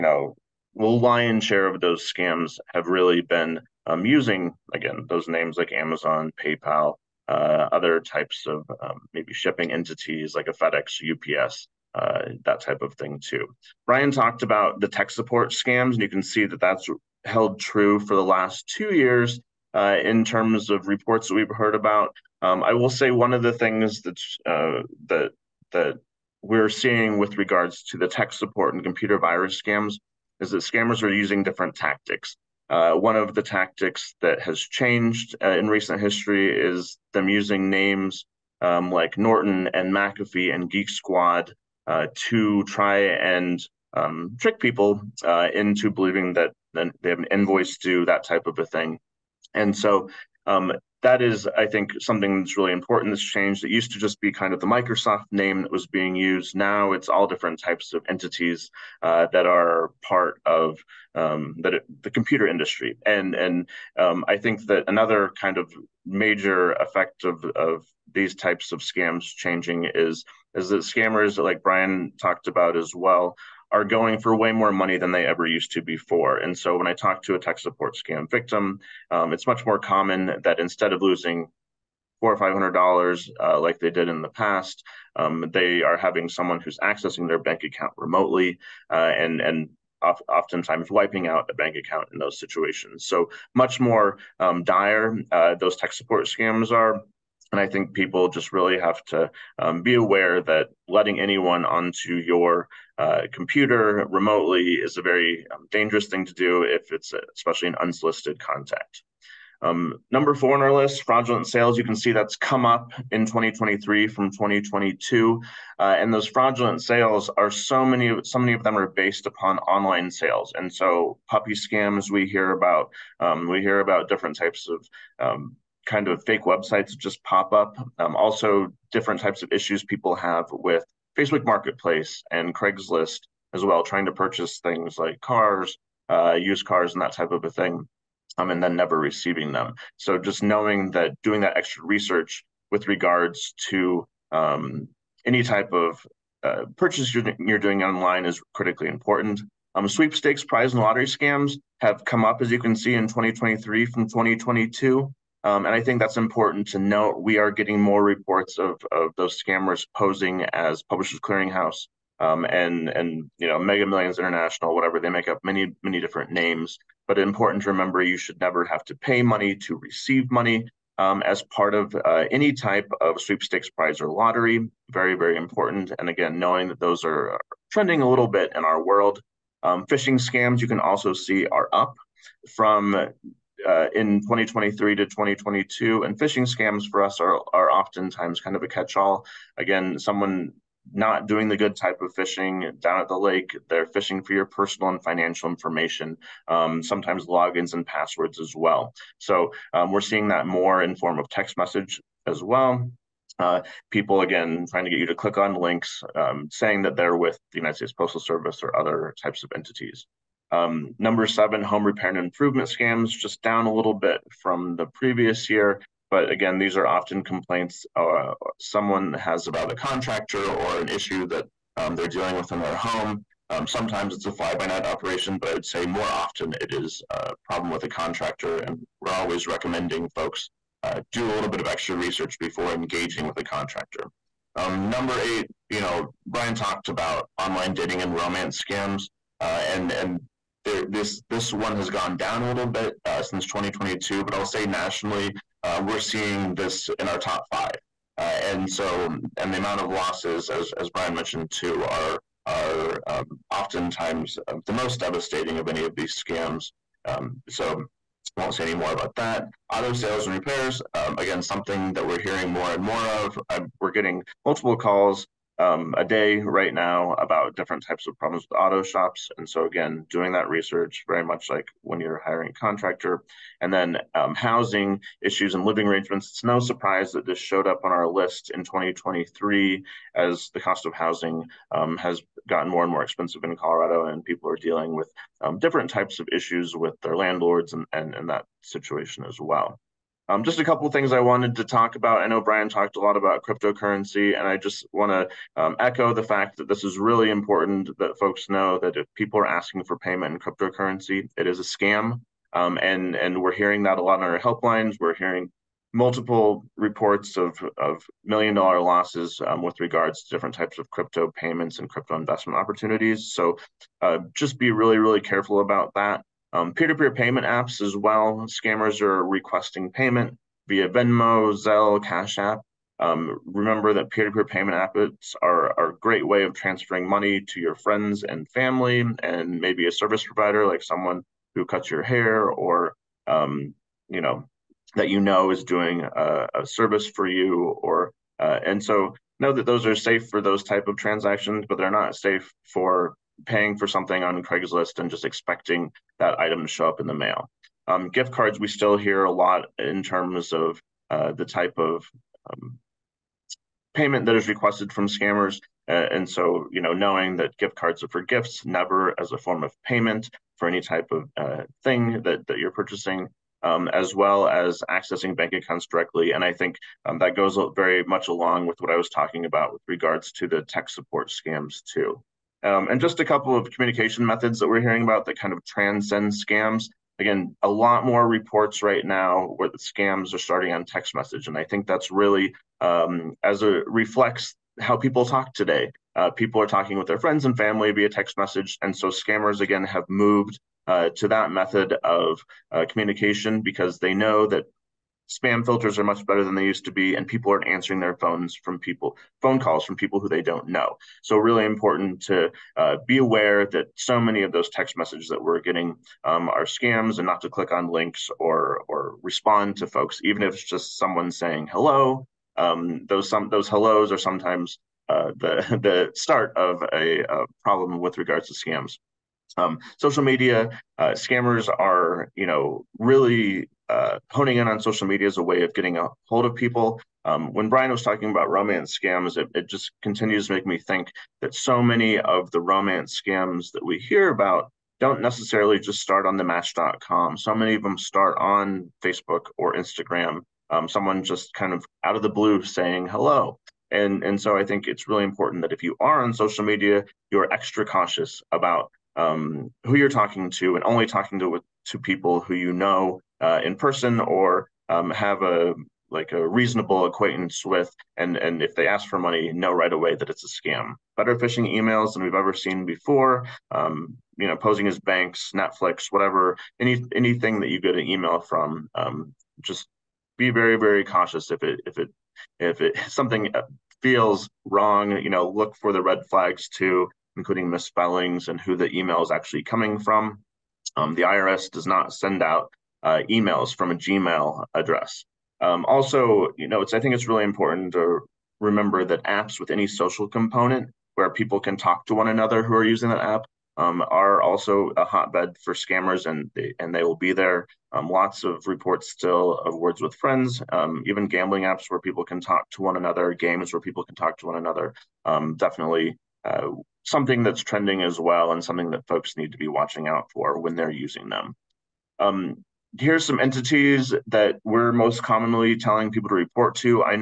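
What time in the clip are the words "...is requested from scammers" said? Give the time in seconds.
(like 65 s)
354 s.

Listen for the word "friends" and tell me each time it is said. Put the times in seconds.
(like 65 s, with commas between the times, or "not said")
327 s, 387 s, 500 s.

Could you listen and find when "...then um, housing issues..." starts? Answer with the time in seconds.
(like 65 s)
273 s.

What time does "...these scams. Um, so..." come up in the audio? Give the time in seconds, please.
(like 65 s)
255 s.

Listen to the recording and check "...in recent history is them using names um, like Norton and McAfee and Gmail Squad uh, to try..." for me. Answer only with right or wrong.
wrong.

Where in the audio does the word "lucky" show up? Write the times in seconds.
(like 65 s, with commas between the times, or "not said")
not said.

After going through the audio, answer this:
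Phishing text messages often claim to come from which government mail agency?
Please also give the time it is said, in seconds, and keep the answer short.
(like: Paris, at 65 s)
United States Postal Service, at 207 s.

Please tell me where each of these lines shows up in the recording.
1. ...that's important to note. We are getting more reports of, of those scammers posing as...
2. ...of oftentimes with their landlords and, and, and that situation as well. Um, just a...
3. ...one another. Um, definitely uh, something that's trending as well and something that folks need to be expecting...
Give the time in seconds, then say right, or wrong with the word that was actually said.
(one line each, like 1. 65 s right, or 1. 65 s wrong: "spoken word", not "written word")
1. 155 s right
2. 286 s wrong: "issues", not "oftentimes"
3. 504 s wrong: "watching", not "expecting".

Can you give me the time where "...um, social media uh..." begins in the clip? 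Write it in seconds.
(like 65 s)
419 s.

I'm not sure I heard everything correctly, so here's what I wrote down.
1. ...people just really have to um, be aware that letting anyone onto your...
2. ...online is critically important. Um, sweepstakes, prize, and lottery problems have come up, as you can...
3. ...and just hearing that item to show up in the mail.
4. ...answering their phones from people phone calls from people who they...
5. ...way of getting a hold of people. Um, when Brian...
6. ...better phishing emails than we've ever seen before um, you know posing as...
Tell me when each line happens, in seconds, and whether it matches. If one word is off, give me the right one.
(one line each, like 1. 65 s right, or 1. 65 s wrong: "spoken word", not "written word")
1. 97 s right
2. 147 s wrong: "scams", not "problems"
3. 344 s wrong: "expecting", not "hearing"
4. 397 s right
5. 425 s right
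6. 461 s right.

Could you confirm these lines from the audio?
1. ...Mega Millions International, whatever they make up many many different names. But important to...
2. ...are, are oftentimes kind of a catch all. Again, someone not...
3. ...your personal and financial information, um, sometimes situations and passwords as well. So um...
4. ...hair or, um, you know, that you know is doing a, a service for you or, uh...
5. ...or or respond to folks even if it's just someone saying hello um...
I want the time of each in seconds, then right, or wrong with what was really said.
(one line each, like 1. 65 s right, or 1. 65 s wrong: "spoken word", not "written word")
1. 163 s right
2. 187 s right
3. 194 s wrong: "logins", not "situations"
4. 332 s right
5. 408 s right.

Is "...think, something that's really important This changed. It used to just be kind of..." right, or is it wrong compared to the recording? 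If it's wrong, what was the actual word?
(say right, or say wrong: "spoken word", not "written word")
right.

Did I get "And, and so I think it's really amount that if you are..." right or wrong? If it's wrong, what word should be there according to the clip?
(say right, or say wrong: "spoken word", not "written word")
wrong: "important", not "amount".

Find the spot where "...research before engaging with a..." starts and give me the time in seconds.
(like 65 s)
231 s.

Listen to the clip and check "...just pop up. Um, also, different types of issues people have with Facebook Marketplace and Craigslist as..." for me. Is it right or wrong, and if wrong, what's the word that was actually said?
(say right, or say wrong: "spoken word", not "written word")
right.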